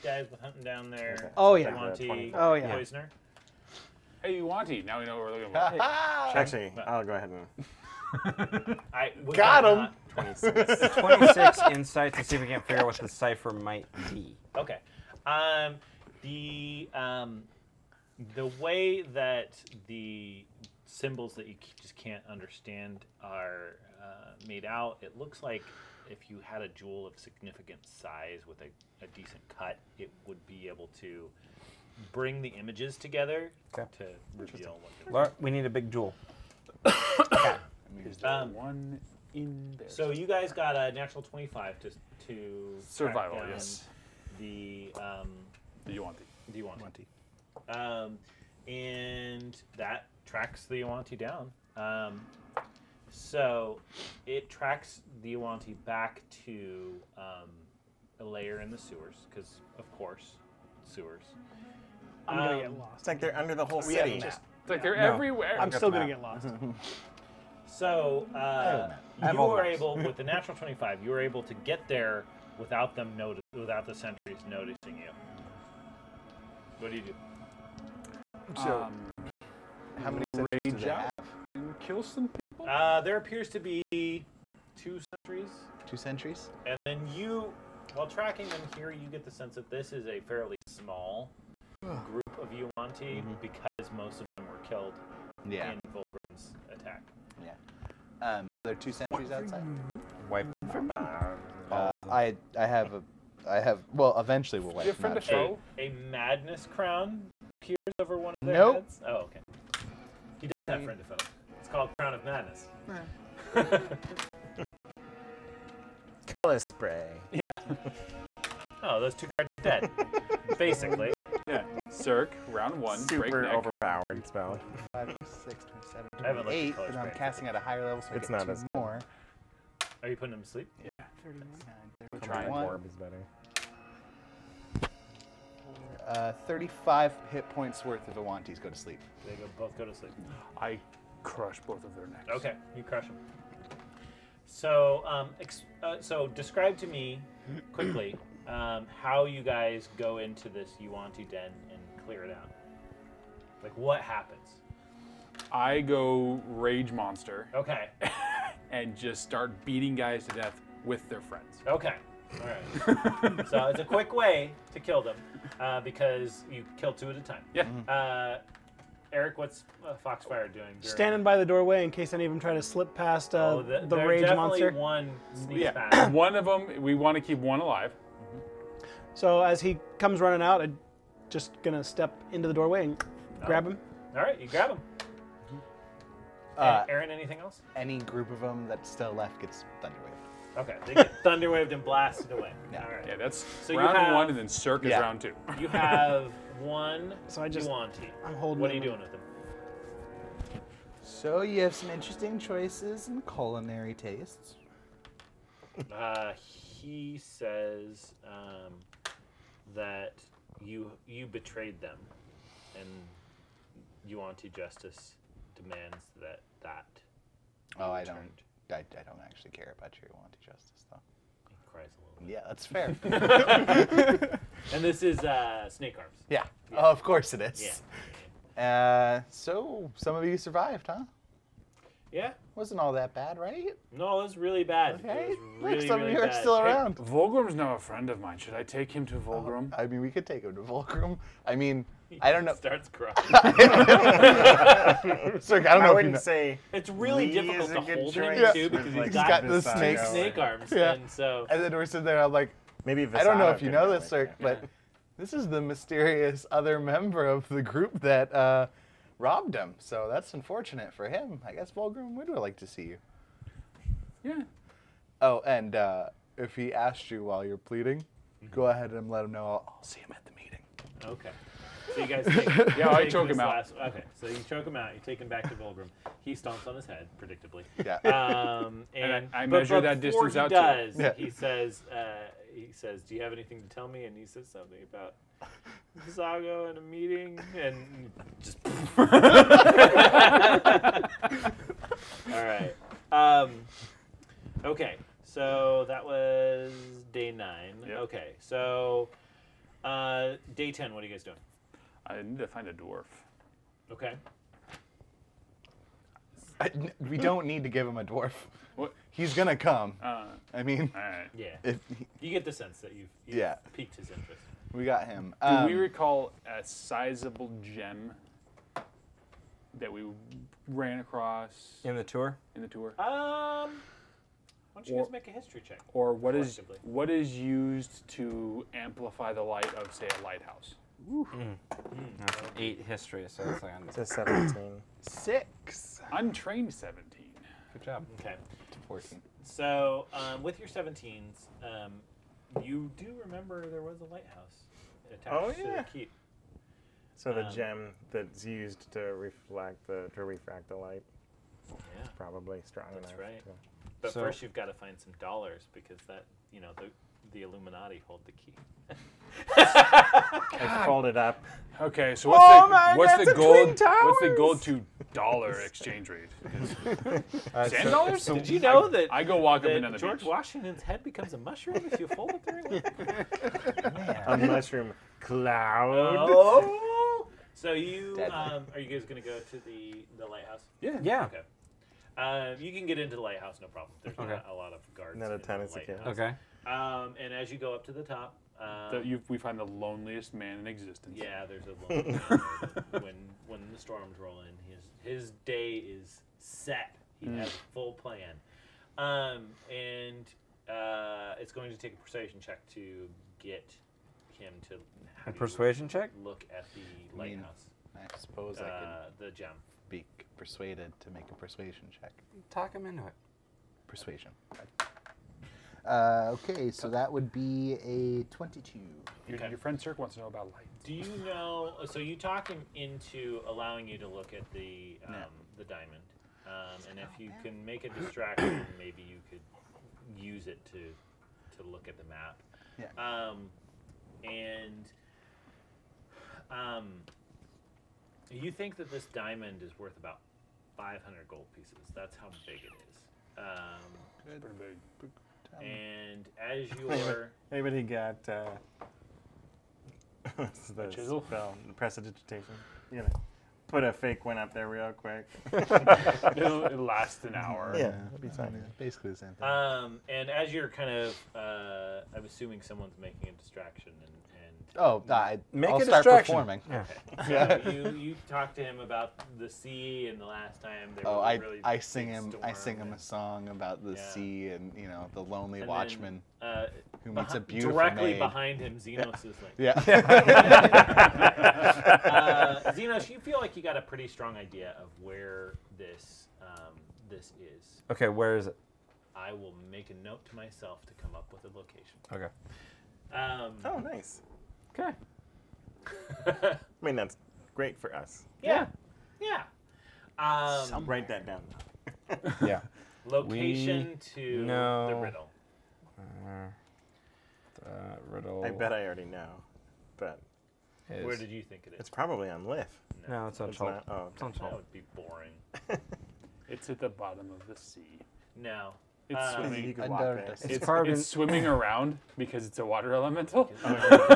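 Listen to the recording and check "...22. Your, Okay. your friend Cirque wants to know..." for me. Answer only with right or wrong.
right.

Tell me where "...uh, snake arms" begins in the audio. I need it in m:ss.
3:45.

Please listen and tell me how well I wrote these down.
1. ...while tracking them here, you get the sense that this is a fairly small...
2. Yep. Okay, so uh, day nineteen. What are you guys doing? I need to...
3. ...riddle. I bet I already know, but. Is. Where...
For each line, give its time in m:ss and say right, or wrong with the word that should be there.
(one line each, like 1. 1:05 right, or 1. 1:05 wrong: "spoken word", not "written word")
1. 1:27 right
2. 4:57 wrong: "ten", not "nineteen"
3. 8:28 right.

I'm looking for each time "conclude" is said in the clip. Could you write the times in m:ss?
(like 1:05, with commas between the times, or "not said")
not said.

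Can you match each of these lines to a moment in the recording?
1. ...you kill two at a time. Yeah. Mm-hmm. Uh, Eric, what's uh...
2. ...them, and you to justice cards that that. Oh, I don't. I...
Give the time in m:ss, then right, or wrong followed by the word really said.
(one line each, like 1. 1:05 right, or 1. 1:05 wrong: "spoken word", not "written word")
1. 2:46 right
2. 3:31 wrong: "demands", not "cards".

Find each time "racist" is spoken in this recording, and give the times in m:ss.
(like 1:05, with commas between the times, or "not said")
not said.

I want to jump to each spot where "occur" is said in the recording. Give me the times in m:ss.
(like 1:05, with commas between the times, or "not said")
not said.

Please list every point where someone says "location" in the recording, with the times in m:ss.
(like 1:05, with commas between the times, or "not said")
8:11, 8:23.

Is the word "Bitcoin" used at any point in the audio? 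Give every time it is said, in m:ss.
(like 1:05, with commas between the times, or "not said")
not said.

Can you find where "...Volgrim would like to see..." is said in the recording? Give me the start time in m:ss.
4:21.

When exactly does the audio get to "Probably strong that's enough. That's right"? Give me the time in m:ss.
5:52.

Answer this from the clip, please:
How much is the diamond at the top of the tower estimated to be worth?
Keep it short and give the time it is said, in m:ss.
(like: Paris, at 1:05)
500 gold pieces, at 7:20.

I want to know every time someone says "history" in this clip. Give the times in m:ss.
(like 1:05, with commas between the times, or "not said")
5:25, 5:32.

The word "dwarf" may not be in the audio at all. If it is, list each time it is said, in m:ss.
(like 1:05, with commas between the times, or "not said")
5:02, 5:08.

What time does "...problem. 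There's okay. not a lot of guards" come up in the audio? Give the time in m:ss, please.
6:23.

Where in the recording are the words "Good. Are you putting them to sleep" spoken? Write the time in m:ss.
2:08.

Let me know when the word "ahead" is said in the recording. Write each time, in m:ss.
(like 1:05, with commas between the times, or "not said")
0:07, 4:28.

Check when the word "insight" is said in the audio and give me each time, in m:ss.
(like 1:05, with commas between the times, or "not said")
0:11.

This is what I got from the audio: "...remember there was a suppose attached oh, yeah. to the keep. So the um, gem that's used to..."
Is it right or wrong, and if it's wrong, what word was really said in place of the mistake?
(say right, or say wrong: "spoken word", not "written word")
wrong: "lighthouse", not "suppose".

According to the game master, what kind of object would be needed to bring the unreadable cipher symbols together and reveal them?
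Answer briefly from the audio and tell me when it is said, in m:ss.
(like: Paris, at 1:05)
A jewel, at 0:26.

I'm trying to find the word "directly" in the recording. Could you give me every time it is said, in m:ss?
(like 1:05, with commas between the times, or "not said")
7:57.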